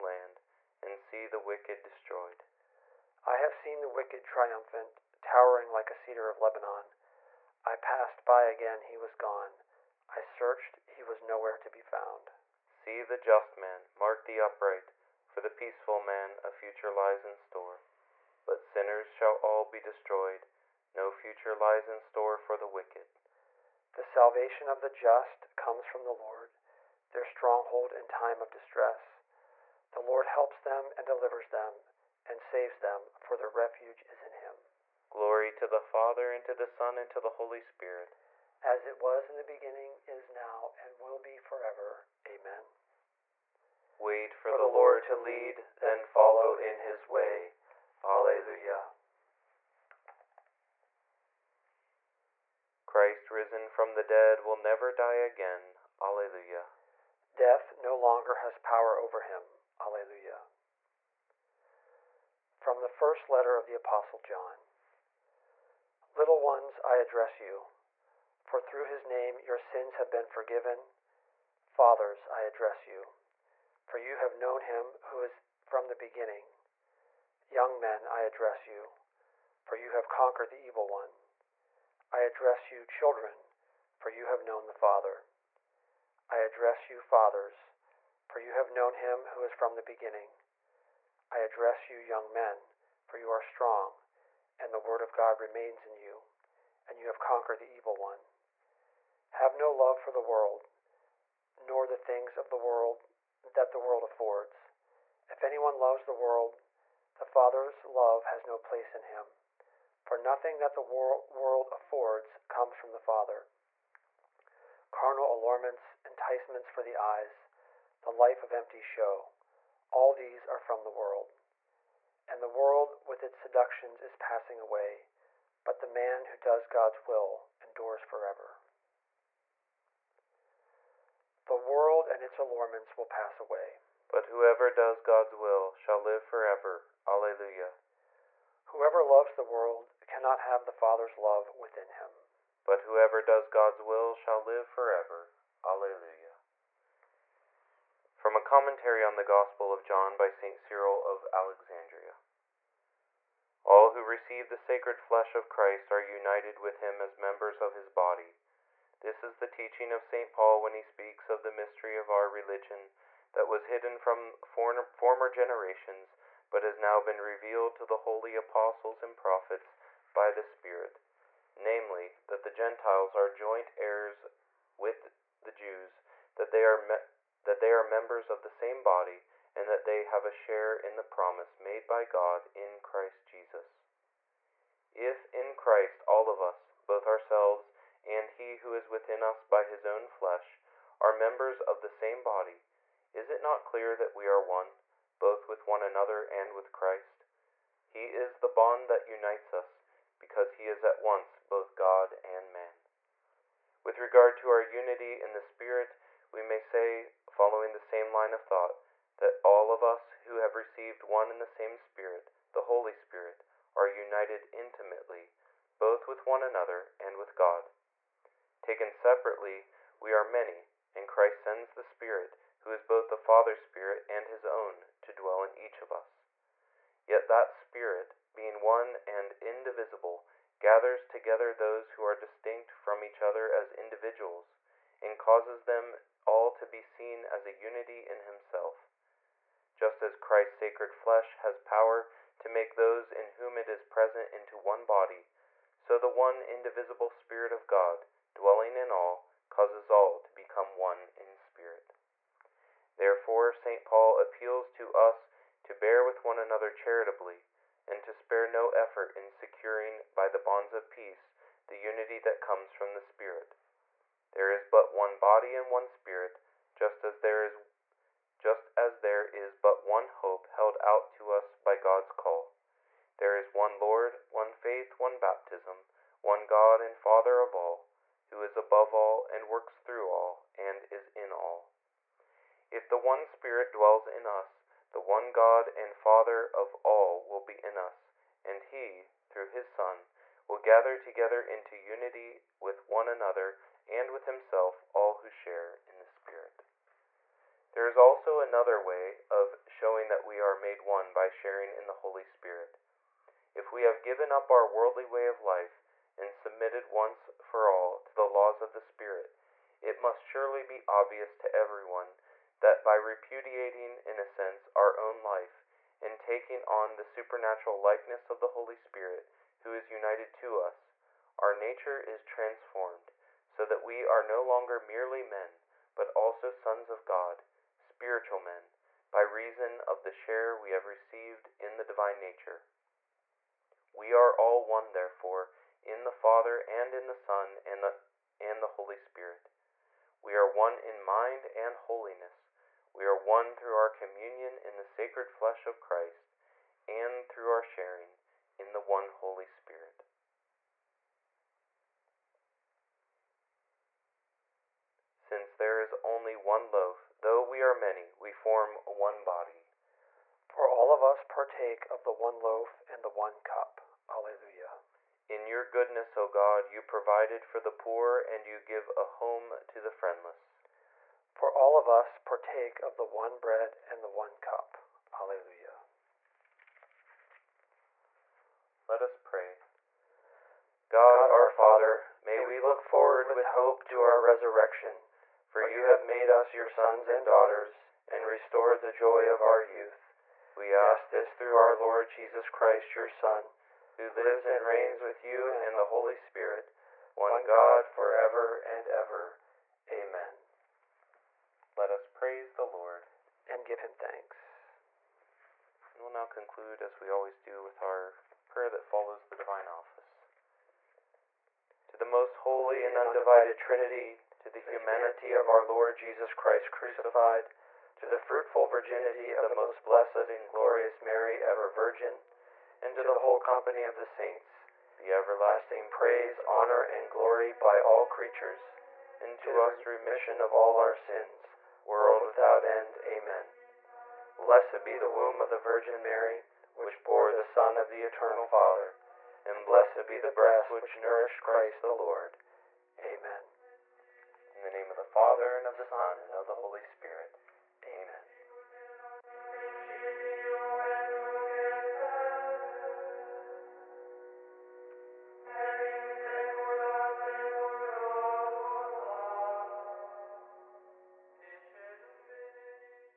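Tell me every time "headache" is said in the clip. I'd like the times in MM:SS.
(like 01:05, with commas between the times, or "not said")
not said.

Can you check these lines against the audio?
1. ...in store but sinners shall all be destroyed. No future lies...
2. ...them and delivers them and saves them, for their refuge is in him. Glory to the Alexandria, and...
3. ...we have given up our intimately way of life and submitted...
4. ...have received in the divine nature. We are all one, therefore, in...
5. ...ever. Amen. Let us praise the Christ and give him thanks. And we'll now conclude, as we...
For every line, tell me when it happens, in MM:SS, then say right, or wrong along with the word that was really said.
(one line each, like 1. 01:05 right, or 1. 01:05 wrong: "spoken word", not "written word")
1. 00:17 right
2. 00:30 wrong: "Father", not "Alexandria"
3. 05:03 wrong: "worldly", not "intimately"
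4. 05:30 right
5. 06:38 wrong: "Lord", not "Christ".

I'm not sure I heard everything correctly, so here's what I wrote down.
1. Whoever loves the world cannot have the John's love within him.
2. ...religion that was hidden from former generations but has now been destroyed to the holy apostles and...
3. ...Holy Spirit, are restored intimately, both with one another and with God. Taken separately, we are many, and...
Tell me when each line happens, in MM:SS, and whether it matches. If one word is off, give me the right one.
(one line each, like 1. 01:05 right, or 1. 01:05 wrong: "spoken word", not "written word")
1. 02:18 wrong: "Father", not "John"
2. 02:42 wrong: "revealed", not "destroyed"
3. 03:32 wrong: "united", not "restored".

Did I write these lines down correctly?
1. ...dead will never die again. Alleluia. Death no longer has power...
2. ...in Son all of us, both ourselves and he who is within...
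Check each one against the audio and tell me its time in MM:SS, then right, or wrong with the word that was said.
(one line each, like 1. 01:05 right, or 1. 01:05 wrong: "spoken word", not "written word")
1. 00:54 right
2. 03:05 wrong: "Christ", not "Son".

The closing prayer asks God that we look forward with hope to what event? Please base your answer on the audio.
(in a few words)
our resurrection.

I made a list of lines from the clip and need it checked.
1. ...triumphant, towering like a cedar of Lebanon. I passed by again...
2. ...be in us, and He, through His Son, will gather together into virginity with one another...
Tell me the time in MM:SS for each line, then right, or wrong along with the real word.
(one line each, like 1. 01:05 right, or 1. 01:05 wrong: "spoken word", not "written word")
1. 00:04 right
2. 04:47 wrong: "unity", not "virginity".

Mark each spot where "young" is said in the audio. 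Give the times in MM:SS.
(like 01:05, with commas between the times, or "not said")
01:17, 01:31.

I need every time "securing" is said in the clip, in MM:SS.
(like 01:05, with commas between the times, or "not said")
04:19.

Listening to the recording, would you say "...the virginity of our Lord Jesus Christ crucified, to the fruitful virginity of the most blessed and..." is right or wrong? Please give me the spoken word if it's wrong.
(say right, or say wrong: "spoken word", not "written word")
wrong: "humanity", not "virginity".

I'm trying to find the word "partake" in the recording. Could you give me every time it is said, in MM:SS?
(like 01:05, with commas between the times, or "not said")
06:01, 06:12.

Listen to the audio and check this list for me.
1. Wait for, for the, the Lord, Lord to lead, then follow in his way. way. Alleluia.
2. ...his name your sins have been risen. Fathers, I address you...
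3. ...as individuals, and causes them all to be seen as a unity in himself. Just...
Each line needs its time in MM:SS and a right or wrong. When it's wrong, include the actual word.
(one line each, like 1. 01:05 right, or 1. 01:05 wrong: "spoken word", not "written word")
1. 00:43 right
2. 01:08 wrong: "forgiven", not "risen"
3. 03:53 right.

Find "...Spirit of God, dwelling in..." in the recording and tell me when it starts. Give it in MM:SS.
04:07.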